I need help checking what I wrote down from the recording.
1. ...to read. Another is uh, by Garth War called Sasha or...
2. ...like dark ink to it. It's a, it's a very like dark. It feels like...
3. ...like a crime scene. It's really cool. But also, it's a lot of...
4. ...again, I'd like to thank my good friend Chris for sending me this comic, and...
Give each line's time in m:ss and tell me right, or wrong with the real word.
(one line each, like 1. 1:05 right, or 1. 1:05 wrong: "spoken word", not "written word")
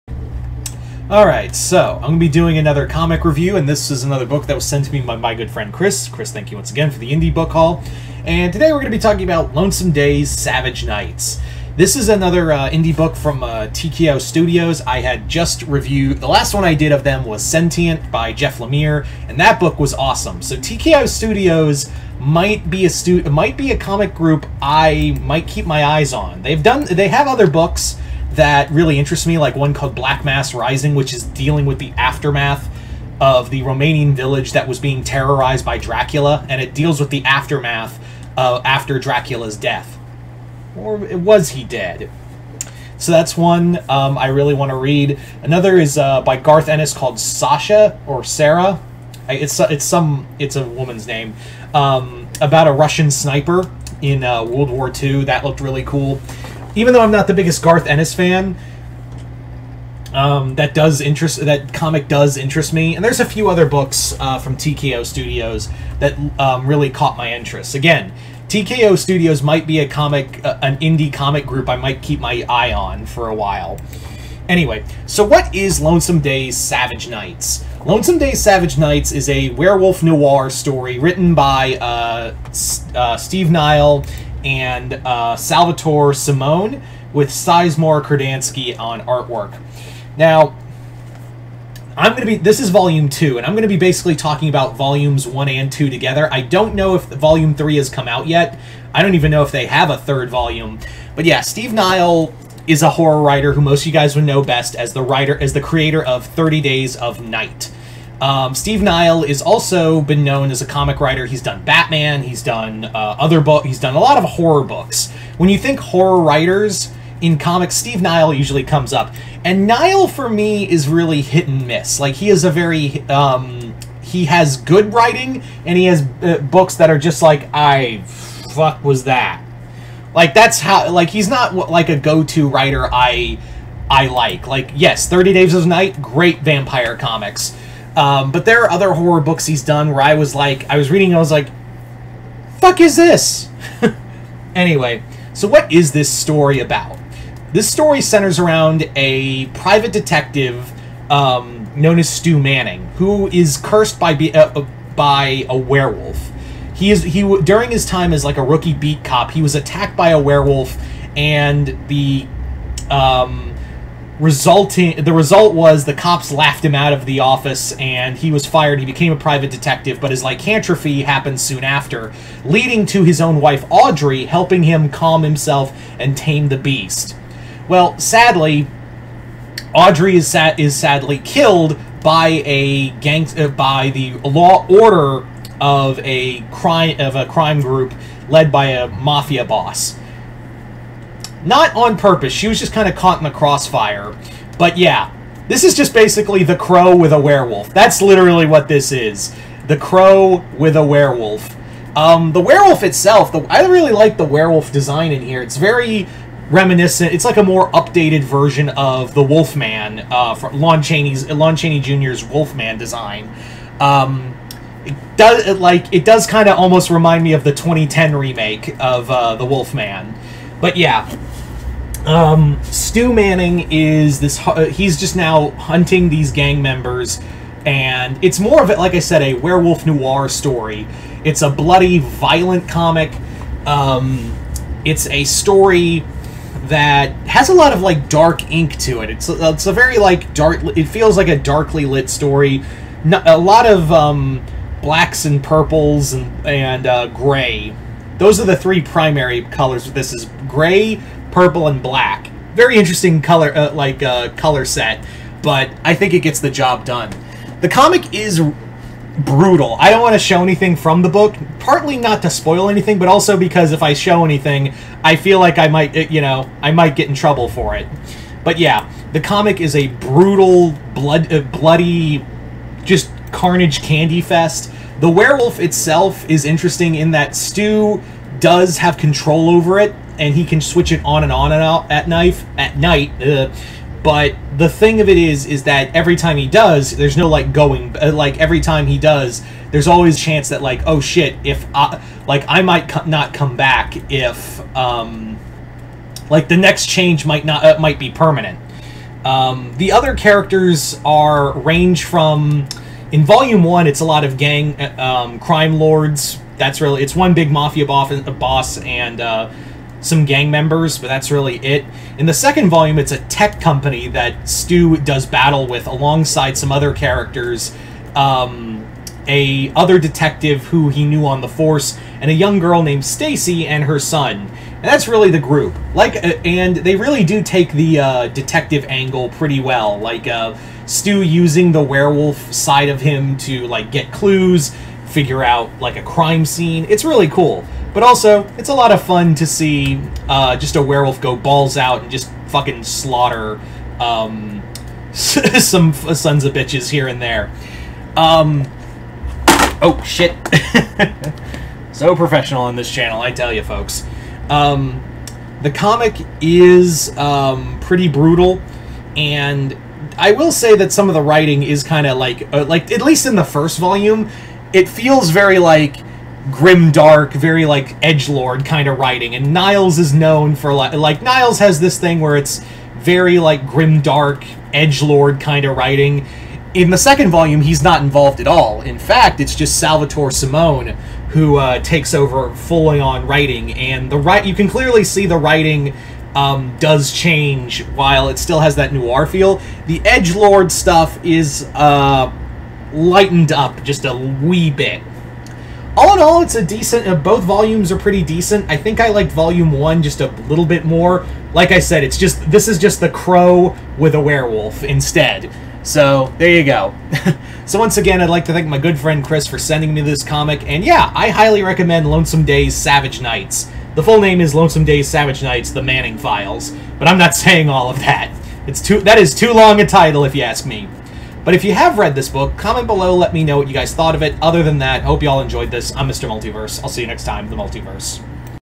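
1. 0:44 wrong: "Ennis", not "War"
2. 3:57 right
3. 5:35 right
4. 6:47 right.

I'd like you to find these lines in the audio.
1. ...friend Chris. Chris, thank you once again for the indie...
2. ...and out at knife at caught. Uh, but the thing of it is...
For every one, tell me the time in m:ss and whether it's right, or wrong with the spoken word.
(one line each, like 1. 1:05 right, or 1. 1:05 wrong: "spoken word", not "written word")
1. 0:05 right
2. 4:41 wrong: "night", not "caught".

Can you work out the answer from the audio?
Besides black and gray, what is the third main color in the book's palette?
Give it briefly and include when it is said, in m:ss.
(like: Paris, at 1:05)
Purple, at 4:11.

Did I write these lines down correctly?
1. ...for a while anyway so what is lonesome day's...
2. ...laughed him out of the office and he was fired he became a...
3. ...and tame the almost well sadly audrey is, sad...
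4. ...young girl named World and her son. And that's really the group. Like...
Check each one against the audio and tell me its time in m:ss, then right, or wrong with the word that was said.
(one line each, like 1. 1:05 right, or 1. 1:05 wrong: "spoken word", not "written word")
1. 1:13 right
2. 2:46 right
3. 2:55 wrong: "beast", not "almost"
4. 5:22 wrong: "Stacy", not "World".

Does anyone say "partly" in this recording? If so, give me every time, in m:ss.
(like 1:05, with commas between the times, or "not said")
4:21.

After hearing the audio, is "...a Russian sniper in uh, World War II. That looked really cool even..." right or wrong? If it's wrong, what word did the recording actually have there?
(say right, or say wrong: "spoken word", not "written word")
right.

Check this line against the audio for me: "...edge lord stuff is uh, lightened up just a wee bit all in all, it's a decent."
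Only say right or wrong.
right.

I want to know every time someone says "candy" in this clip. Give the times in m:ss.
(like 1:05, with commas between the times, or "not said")
4:33.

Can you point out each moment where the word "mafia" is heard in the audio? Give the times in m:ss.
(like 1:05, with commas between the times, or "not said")
3:08, 5:07.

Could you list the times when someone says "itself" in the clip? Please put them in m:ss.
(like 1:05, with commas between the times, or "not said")
3:22, 4:35.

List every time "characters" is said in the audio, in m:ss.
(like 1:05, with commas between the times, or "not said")
5:00, 5:16.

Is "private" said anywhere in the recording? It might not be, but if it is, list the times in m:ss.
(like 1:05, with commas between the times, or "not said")
2:29, 2:49.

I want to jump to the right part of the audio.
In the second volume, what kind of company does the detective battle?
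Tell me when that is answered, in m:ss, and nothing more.
5:13.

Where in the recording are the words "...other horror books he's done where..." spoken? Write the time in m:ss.
2:18.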